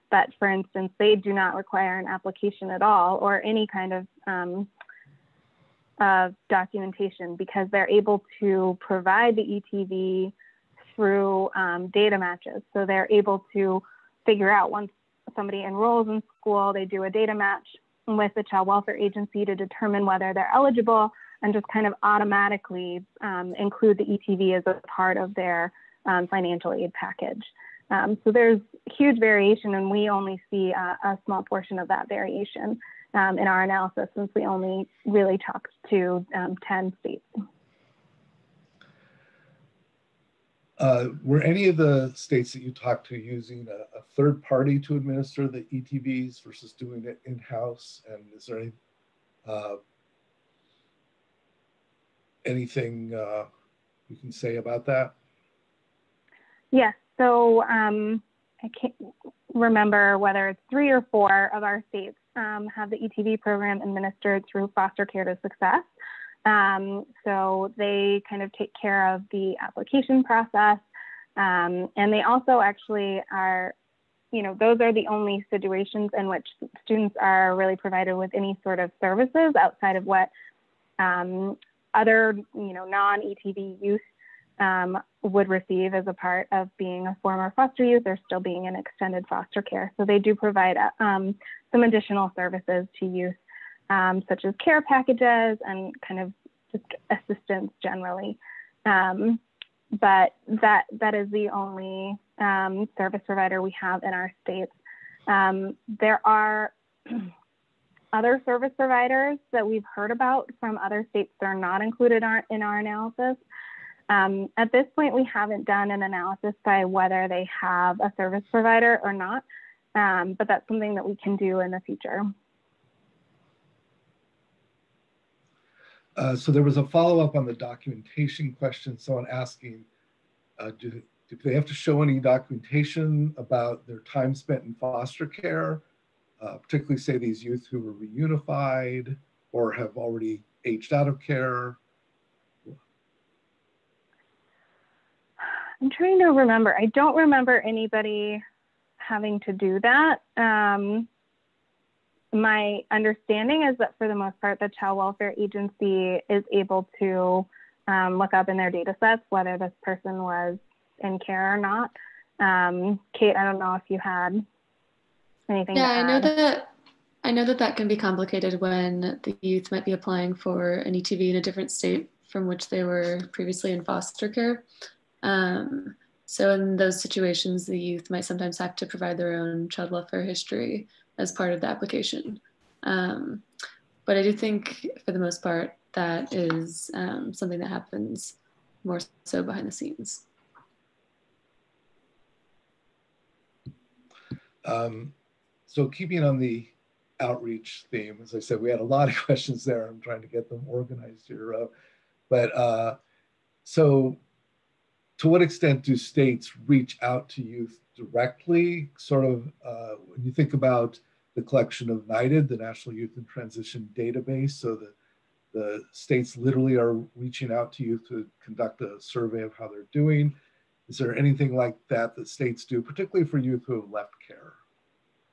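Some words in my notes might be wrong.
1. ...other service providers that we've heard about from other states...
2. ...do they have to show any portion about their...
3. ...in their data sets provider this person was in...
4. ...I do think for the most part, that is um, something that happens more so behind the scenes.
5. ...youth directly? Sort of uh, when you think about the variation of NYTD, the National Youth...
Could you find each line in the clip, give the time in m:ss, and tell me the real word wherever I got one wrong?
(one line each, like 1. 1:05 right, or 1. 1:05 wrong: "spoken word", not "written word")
1. 1:48 right
2. 2:11 wrong: "documentation", not "portion"
3. 2:38 wrong: "whether", not "provider"
4. 3:04 right
5. 3:27 wrong: "collection", not "variation".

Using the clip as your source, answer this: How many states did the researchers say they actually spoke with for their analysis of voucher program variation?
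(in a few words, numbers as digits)
10.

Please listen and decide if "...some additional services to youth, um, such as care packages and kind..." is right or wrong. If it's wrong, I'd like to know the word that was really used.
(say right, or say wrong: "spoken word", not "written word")
right.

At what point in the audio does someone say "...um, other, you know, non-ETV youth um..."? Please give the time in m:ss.
1:20.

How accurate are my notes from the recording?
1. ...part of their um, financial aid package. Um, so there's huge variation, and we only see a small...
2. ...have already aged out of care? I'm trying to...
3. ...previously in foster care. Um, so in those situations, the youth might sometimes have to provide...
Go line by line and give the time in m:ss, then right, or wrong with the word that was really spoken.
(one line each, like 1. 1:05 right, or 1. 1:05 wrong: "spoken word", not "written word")
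1. 0:24 right
2. 2:19 right
3. 2:53 right.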